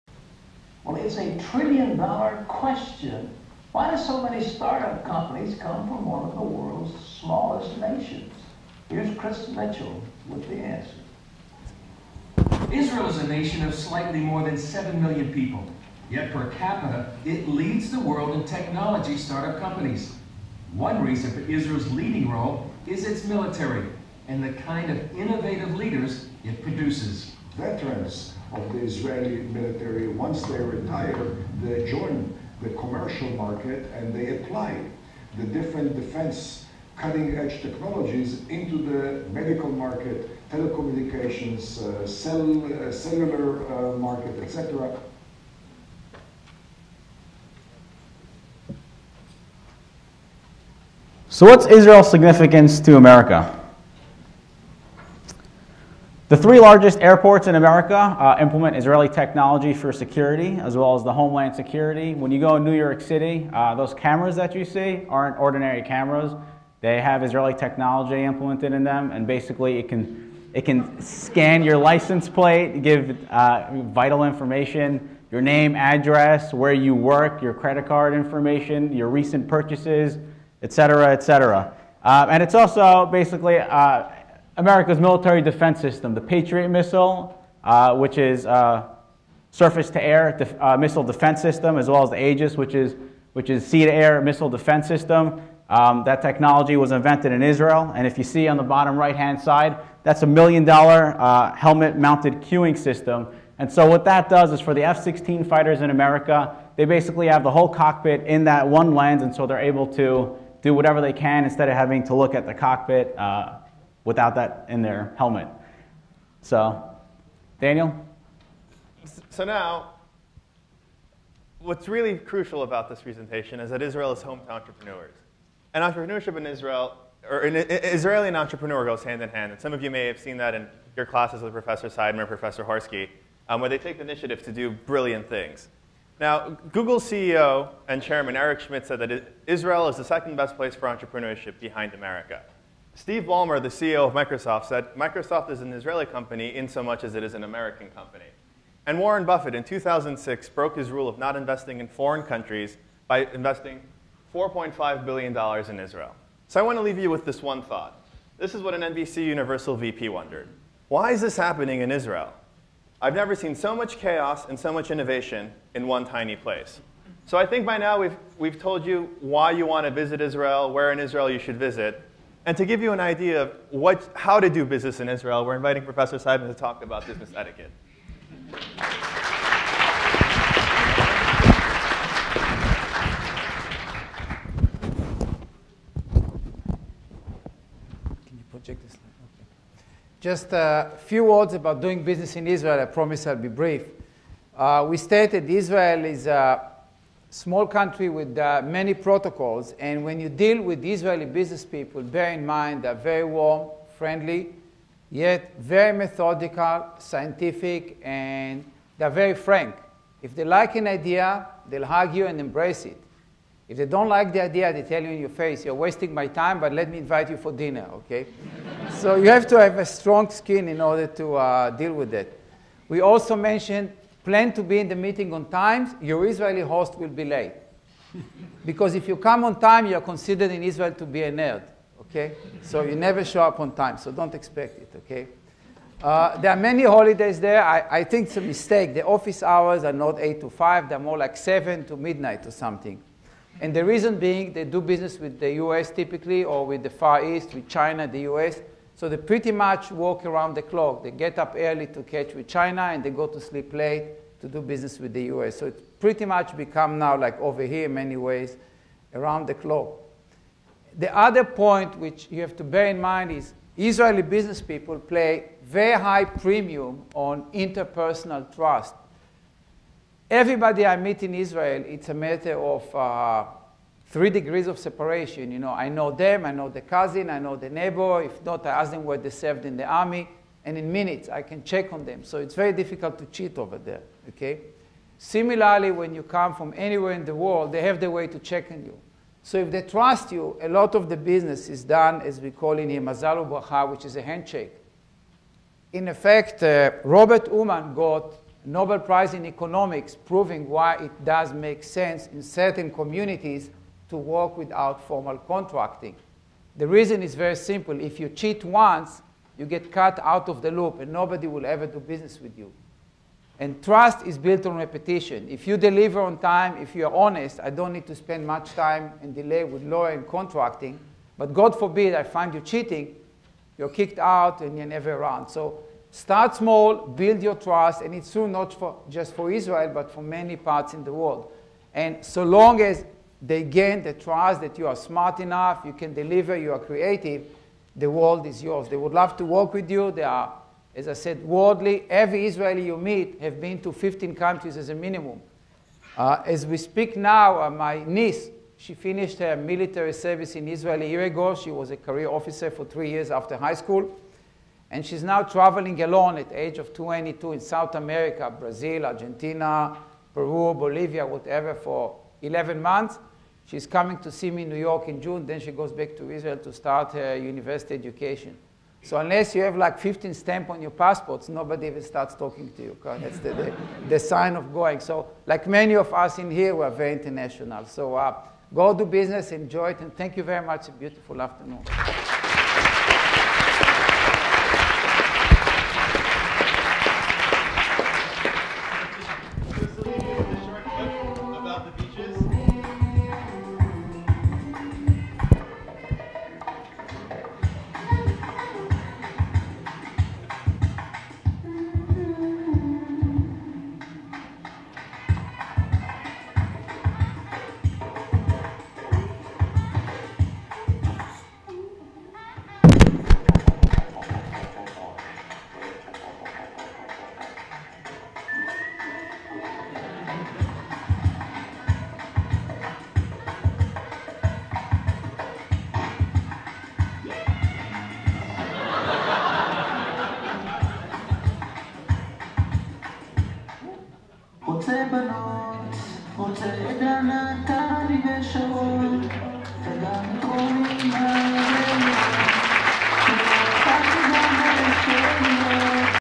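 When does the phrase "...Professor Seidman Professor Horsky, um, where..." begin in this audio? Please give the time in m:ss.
2:11.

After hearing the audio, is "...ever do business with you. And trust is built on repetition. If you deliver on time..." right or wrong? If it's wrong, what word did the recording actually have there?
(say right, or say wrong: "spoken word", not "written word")
right.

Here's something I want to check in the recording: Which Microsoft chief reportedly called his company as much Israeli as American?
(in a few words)
Steve Ballmer.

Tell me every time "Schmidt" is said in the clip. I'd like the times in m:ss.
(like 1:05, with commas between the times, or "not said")
2:18.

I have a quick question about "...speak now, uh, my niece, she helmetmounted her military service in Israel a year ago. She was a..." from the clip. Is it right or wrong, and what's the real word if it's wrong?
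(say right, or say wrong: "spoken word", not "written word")
wrong: "finished", not "helmetmounted".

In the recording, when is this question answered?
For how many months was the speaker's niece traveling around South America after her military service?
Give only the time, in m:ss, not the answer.
6:02.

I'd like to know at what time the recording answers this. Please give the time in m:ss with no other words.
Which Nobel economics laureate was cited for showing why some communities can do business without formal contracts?
4:57.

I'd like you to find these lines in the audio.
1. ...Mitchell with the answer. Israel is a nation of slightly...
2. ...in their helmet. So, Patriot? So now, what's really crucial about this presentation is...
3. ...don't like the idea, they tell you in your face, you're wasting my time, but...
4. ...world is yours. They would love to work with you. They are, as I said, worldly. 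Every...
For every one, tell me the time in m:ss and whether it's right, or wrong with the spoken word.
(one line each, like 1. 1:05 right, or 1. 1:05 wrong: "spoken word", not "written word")
1. 0:09 right
2. 1:54 wrong: "Daniel", not "Patriot"
3. 3:33 right
4. 5:38 right.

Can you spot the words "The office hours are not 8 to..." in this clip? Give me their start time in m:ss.
3:58.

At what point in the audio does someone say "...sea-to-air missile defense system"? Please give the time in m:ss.
1:33.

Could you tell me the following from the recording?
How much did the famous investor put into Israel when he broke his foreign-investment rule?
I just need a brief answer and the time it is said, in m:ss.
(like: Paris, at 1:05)
$4.5 billion, at 2:34.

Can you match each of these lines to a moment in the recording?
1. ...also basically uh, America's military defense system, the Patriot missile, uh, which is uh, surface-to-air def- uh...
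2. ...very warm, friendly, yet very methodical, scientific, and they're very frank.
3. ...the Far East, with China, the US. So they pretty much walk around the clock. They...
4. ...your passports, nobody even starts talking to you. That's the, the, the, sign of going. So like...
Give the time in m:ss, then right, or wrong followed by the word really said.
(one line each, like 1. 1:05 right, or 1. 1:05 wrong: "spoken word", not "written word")
1. 1:22 right
2. 3:22 right
3. 4:06 right
4. 6:10 right.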